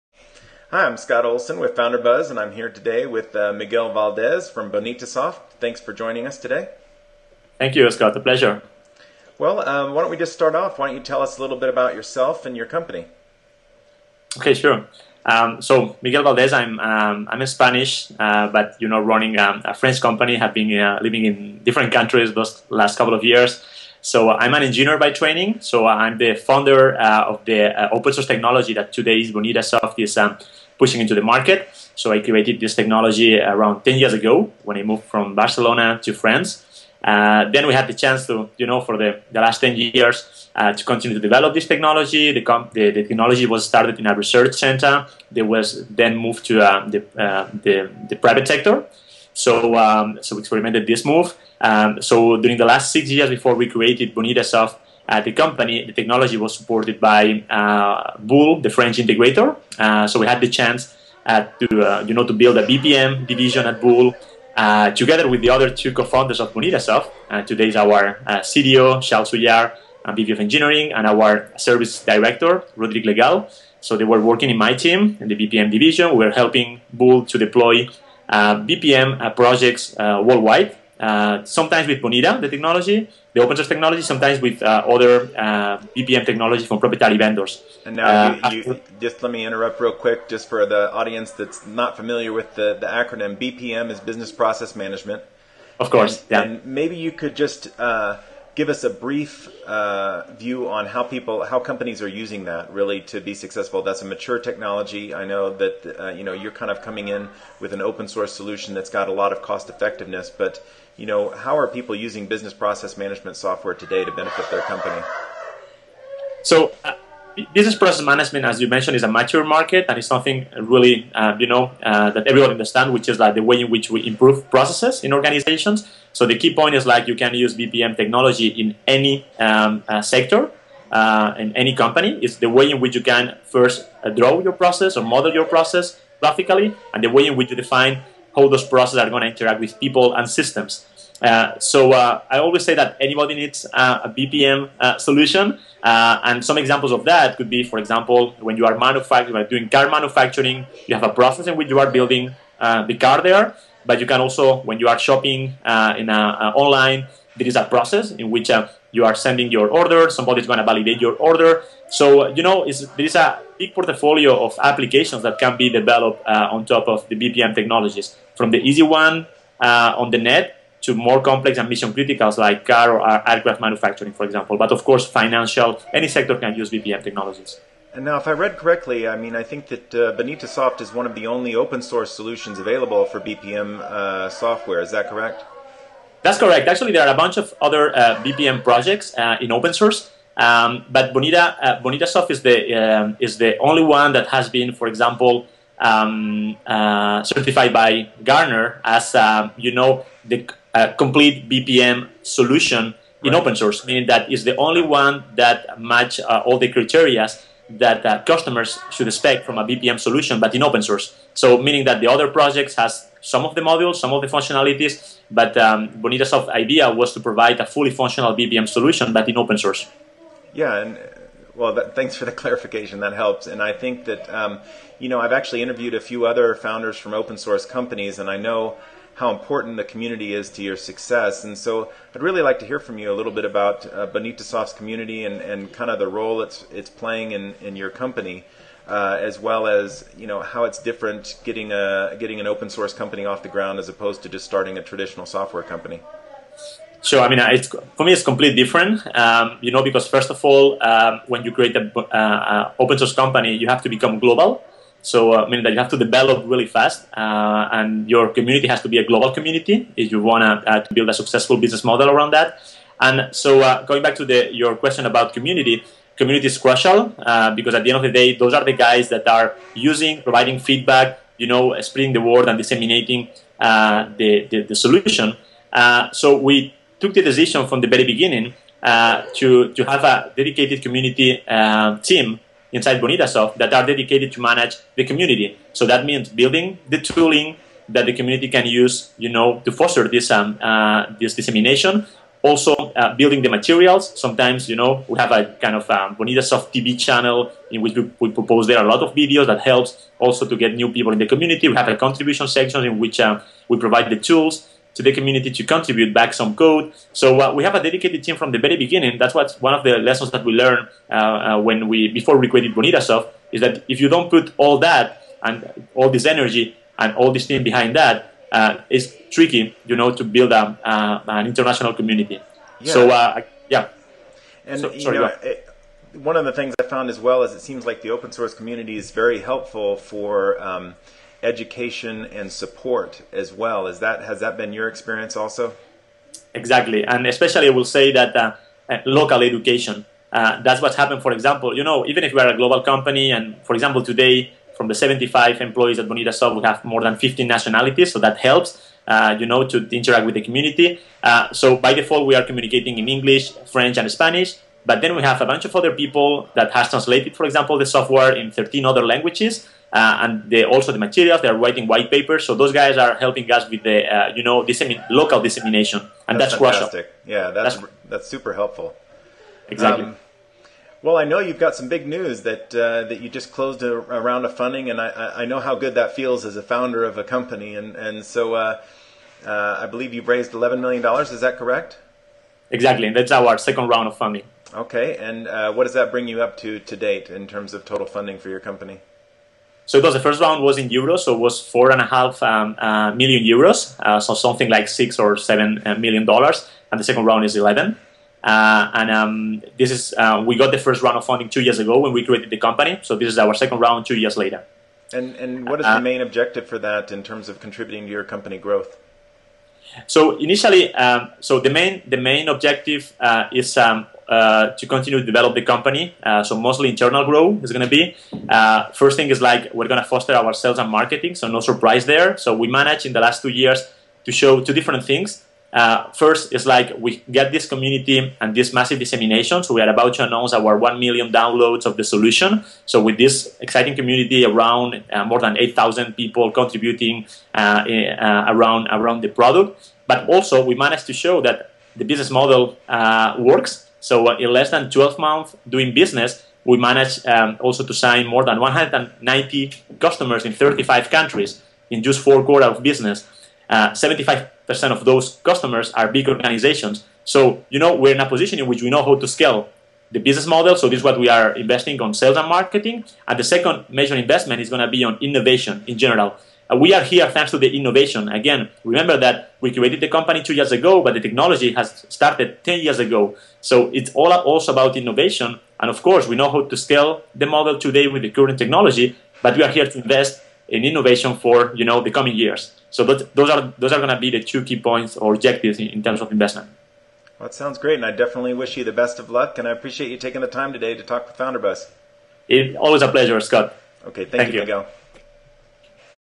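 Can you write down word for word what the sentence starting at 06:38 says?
Uh, and um, this is uh, we got the first round of funding two years ago when we created the company.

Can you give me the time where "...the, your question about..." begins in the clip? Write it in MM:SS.
04:24.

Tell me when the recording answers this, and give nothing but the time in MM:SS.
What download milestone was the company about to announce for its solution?
07:10.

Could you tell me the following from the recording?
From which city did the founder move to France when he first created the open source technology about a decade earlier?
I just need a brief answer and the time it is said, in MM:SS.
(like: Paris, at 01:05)
Barcelona, at 00:35.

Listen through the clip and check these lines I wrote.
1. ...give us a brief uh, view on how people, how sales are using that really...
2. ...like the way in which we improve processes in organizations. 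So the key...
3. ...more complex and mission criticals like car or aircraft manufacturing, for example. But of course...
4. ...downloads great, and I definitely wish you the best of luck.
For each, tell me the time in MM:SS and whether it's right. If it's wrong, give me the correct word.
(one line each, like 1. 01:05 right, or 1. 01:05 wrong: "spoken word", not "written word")
1. 01:38 wrong: "companies", not "sales"
2. 02:03 right
3. 02:50 right
4. 08:07 wrong: "sounds", not "downloads".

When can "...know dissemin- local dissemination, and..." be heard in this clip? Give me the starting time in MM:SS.
06:04.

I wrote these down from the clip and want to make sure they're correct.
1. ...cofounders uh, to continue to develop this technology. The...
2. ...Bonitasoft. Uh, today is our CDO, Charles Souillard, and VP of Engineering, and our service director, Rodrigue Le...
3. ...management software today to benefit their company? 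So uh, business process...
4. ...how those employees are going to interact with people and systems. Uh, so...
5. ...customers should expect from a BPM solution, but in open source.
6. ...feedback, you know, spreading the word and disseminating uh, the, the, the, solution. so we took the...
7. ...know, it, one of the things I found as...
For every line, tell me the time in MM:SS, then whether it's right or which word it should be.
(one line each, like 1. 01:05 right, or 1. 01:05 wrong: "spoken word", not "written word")
1. 00:39 wrong: "years", not "cofounders"
2. 01:06 right
3. 01:52 right
4. 02:18 wrong: "processes", not "employees"
5. 03:28 right
6. 04:30 right
7. 05:25 right.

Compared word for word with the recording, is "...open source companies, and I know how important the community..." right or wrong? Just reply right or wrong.
right.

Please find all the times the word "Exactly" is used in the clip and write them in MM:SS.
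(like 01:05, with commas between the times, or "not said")
05:36, 06:09, 06:22.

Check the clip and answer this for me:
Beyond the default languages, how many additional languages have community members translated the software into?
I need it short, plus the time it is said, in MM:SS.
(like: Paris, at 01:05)
13, at 05:58.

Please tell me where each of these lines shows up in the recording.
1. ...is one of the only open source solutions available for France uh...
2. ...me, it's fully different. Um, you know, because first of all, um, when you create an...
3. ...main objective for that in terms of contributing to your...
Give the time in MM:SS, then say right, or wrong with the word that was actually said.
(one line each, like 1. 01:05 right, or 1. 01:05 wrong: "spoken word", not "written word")
1. 03:00 wrong: "BPM", not "France"
2. 04:08 wrong: "completely", not "fully"
3. 06:45 right.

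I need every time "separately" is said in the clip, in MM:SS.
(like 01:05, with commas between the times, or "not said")
not said.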